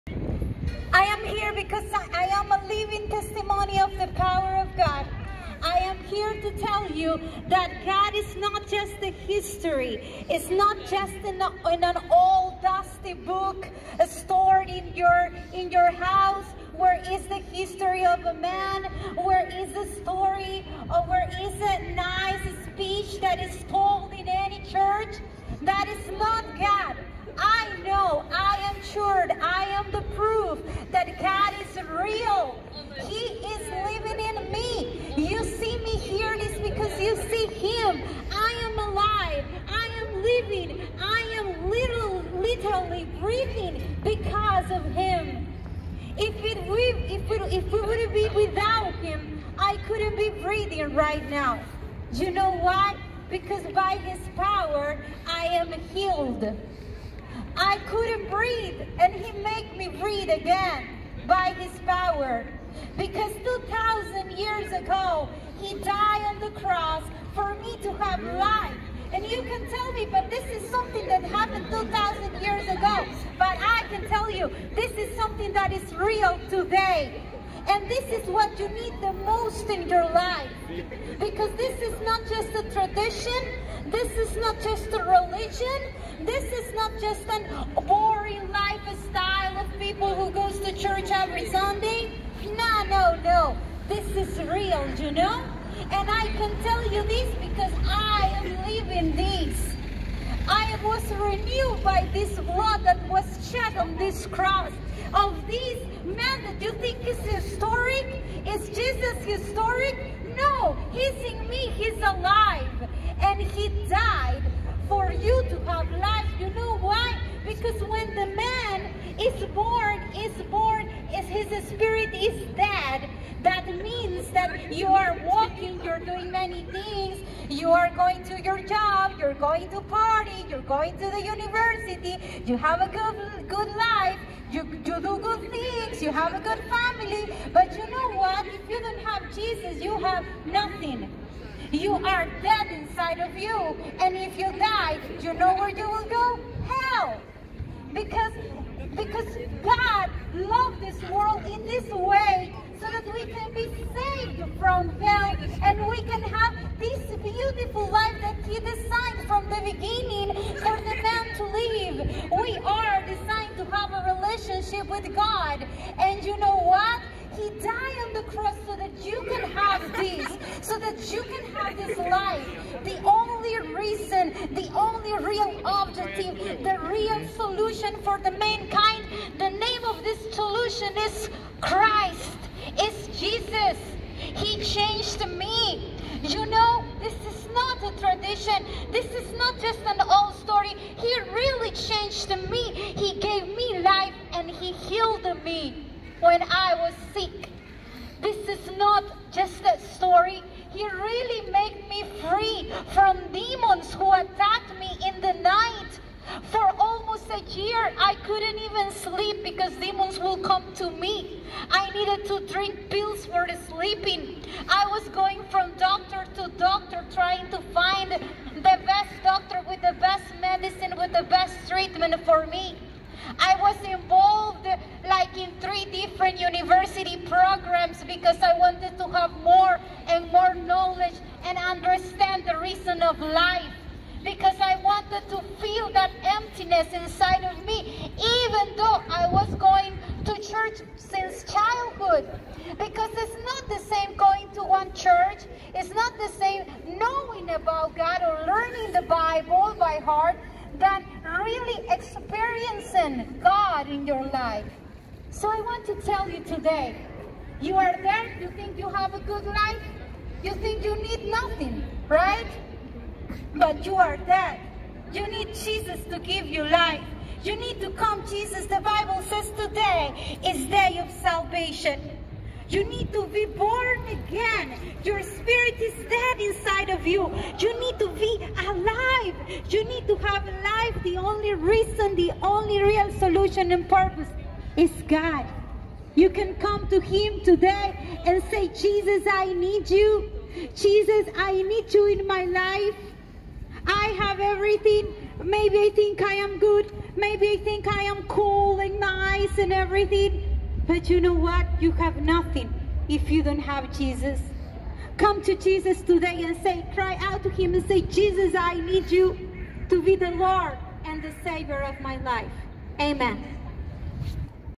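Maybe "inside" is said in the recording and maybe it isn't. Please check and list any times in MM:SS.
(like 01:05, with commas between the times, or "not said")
02:22, 03:56, 04:36.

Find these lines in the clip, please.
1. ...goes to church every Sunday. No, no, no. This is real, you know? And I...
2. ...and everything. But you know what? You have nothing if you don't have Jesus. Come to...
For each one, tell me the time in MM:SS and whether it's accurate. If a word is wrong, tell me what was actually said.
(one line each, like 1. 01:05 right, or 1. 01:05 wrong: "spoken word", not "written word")
1. 01:30 right
2. 04:59 right.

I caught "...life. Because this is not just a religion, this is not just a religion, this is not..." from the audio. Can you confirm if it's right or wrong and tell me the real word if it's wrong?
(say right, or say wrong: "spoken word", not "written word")
wrong: "tradition", not "religion".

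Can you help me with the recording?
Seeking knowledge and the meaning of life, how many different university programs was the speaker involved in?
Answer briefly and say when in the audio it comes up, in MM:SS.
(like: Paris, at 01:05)
3, at 03:45.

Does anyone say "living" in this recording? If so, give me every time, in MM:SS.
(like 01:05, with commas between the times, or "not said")
00:02, 00:40.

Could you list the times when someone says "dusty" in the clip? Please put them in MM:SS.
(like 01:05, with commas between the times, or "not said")
00:12.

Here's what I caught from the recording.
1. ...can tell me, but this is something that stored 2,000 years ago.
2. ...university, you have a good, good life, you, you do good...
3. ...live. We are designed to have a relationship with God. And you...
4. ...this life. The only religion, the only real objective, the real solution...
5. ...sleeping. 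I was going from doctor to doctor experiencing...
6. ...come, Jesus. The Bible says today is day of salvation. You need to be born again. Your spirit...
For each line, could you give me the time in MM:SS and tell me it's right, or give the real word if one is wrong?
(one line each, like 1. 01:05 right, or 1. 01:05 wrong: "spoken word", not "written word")
1. 01:09 wrong: "happened", not "stored"
2. 02:11 right
3. 02:41 right
4. 02:51 wrong: "reason", not "religion"
5. 03:33 wrong: "trying", not "experiencing"
6. 04:27 right.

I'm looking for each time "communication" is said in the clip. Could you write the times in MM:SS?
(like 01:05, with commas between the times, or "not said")
not said.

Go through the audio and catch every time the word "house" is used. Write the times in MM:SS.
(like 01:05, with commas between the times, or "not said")
00:15.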